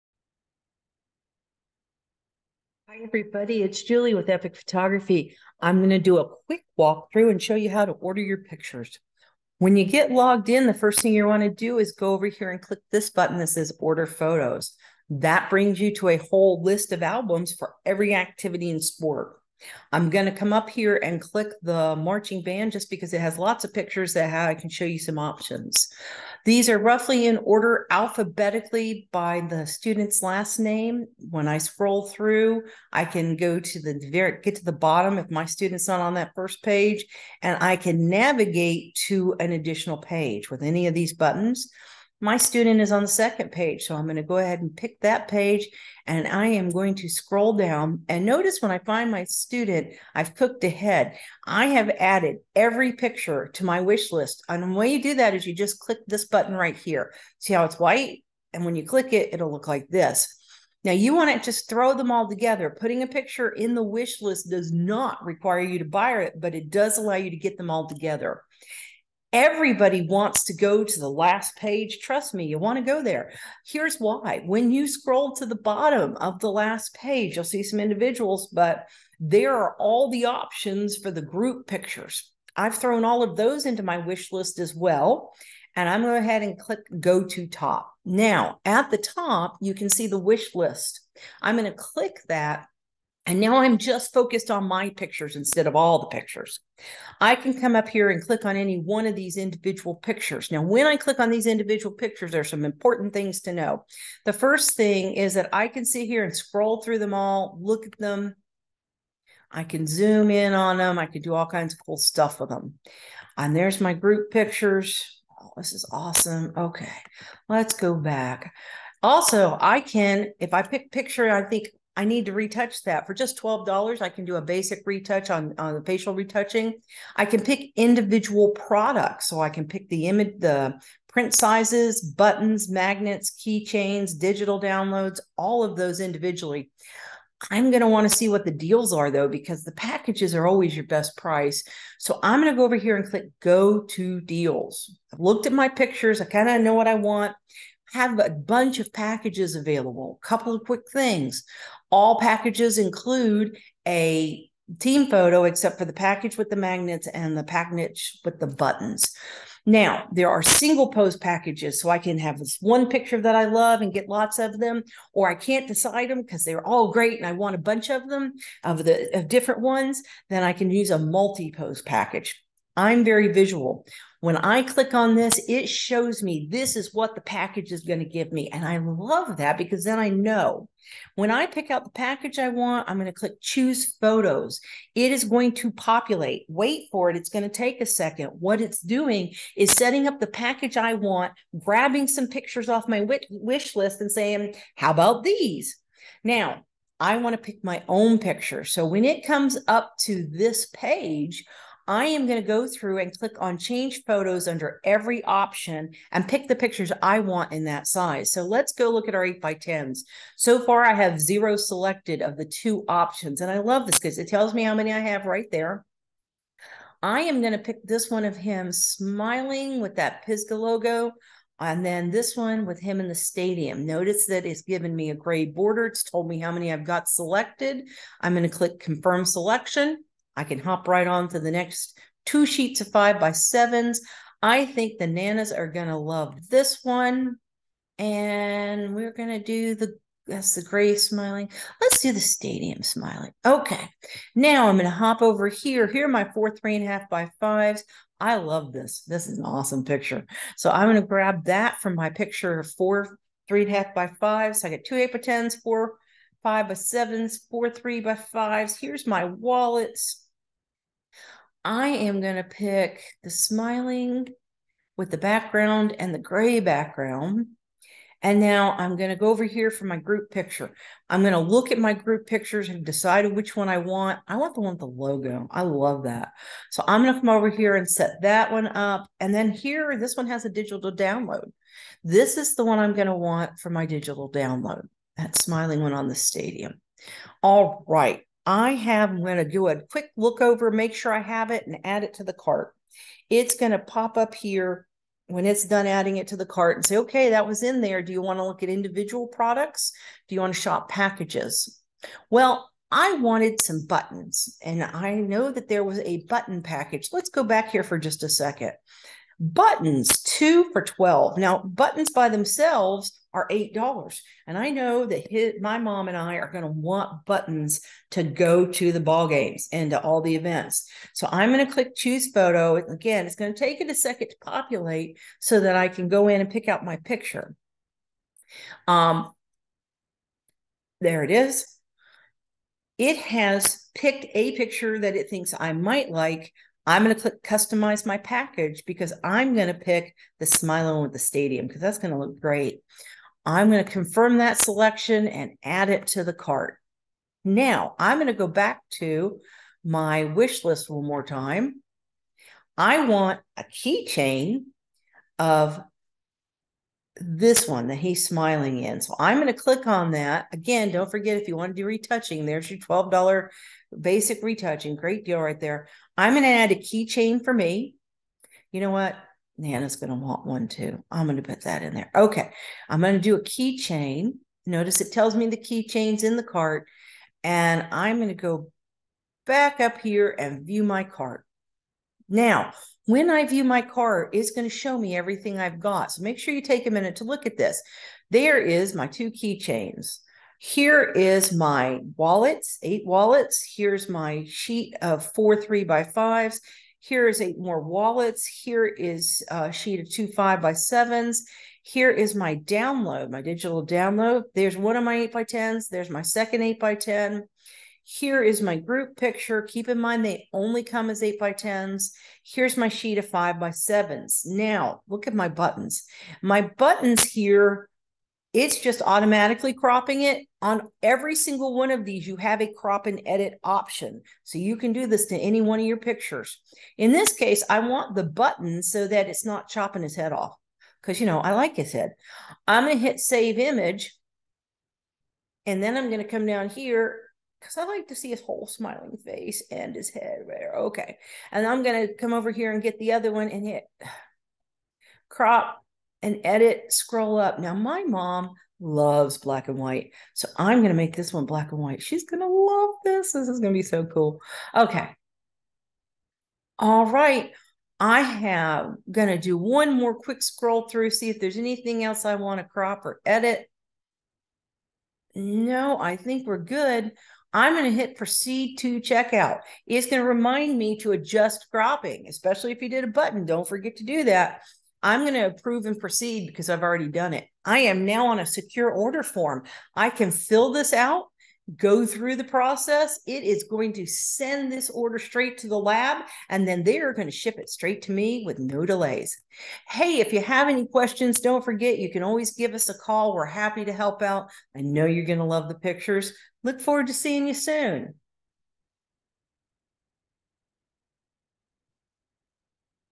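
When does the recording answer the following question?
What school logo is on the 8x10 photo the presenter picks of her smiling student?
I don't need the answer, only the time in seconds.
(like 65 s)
220 s.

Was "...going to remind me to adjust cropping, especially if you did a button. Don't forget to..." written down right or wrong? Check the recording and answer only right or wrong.
right.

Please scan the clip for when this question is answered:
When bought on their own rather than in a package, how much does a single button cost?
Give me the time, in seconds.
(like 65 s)
313 s.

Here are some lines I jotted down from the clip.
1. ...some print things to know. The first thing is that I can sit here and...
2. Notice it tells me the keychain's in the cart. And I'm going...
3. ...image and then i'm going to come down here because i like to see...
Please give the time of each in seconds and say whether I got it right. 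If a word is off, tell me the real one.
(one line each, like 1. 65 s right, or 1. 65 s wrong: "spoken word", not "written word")
1. 102 s wrong: "important", not "print"
2. 374 s right
3. 433 s right.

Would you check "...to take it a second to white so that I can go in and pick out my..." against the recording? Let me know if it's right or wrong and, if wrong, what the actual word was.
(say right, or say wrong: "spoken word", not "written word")
wrong: "populate", not "white".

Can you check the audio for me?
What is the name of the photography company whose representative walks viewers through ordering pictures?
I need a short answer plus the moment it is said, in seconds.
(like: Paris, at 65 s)
Epic Photography, at 4 s.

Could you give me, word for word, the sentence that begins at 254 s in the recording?
So I got two eight by tens, four, five by sevens, four, three by fives.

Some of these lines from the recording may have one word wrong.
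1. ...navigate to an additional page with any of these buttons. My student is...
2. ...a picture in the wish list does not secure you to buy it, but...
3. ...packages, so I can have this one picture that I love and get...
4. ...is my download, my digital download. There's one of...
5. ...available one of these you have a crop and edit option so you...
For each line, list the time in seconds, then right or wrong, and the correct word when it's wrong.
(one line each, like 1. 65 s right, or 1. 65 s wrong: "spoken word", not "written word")
1. 38 s right
2. 63 s wrong: "require", not "secure"
3. 161 s right
4. 402 s right
5. 421 s wrong: "single", not "available".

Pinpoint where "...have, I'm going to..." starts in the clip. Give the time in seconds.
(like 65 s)
288 s.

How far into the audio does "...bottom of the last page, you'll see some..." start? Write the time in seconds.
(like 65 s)
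75 s.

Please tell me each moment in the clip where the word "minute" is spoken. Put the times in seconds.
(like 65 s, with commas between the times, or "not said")
386 s.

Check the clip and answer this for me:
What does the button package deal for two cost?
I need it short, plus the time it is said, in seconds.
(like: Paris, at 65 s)
two for 12, at 310 s.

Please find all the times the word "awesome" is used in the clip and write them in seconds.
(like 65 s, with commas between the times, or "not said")
115 s, 249 s.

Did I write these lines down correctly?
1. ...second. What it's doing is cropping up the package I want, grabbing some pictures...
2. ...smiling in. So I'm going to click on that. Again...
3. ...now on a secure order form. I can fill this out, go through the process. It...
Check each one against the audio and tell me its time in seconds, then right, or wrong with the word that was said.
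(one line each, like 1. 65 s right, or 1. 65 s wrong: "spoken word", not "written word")
1. 187 s wrong: "setting", not "cropping"
2. 358 s right
3. 478 s right.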